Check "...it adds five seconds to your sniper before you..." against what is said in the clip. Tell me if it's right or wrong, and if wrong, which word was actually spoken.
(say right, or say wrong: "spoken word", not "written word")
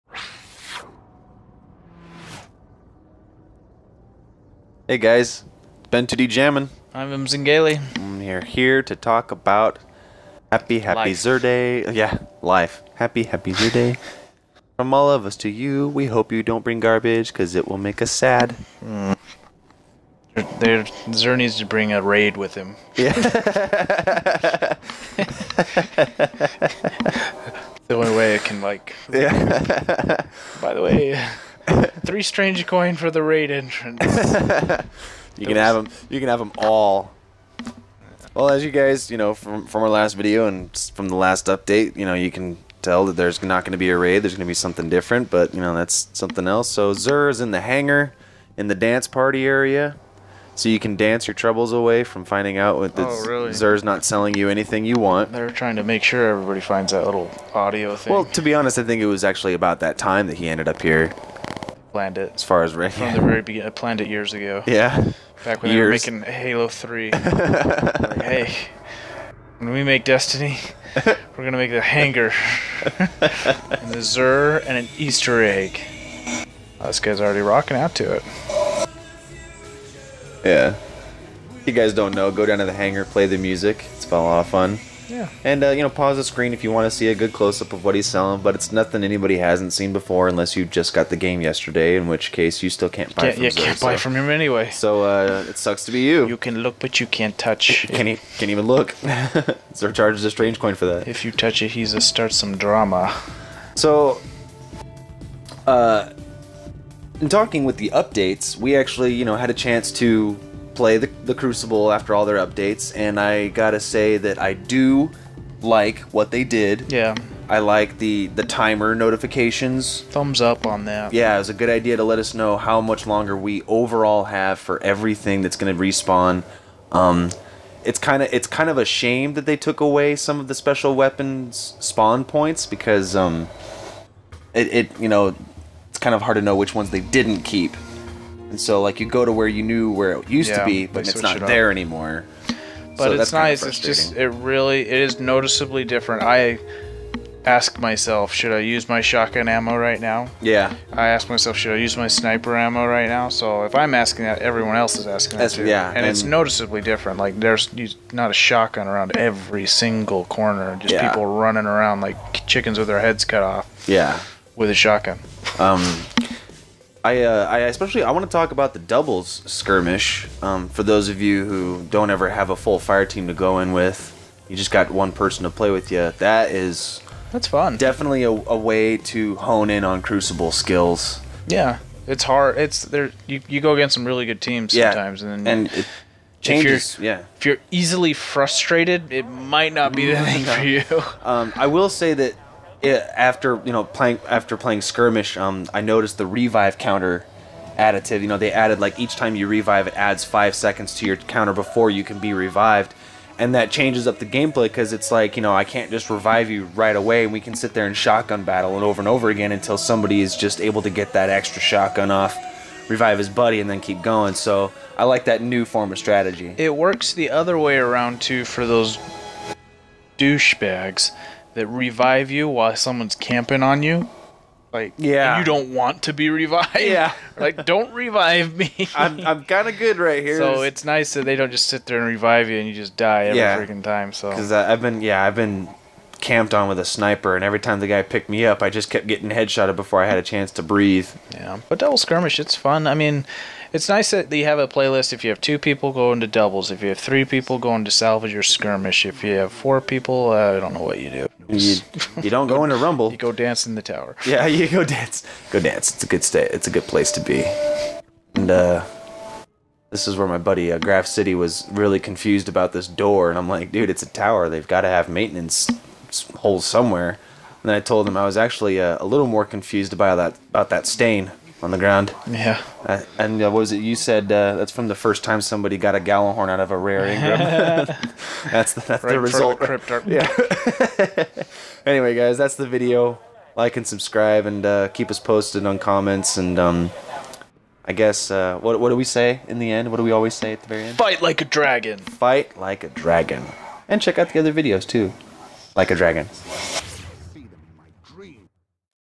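wrong: "counter", not "sniper".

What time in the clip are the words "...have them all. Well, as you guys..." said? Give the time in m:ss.
0:36.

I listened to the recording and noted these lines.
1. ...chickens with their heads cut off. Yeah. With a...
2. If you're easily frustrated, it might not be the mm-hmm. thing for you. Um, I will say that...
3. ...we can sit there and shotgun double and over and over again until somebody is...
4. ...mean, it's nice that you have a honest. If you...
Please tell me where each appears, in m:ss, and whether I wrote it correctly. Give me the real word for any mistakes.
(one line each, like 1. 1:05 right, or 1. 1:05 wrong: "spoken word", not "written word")
1. 2:42 right
2. 3:07 right
3. 3:27 wrong: "battle", not "double"
4. 4:02 wrong: "playlist", not "honest".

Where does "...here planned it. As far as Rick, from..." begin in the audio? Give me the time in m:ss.
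1:00.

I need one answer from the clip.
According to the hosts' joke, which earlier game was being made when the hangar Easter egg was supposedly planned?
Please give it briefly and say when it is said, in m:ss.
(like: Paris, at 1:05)
Halo 3, at 1:06.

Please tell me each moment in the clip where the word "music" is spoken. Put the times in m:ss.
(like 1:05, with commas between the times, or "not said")
1:23.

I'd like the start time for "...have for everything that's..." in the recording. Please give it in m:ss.
2:04.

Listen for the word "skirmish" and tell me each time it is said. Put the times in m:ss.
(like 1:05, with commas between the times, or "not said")
2:49, 3:14, 4:01, 4:08.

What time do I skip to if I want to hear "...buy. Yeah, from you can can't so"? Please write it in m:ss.
1:33.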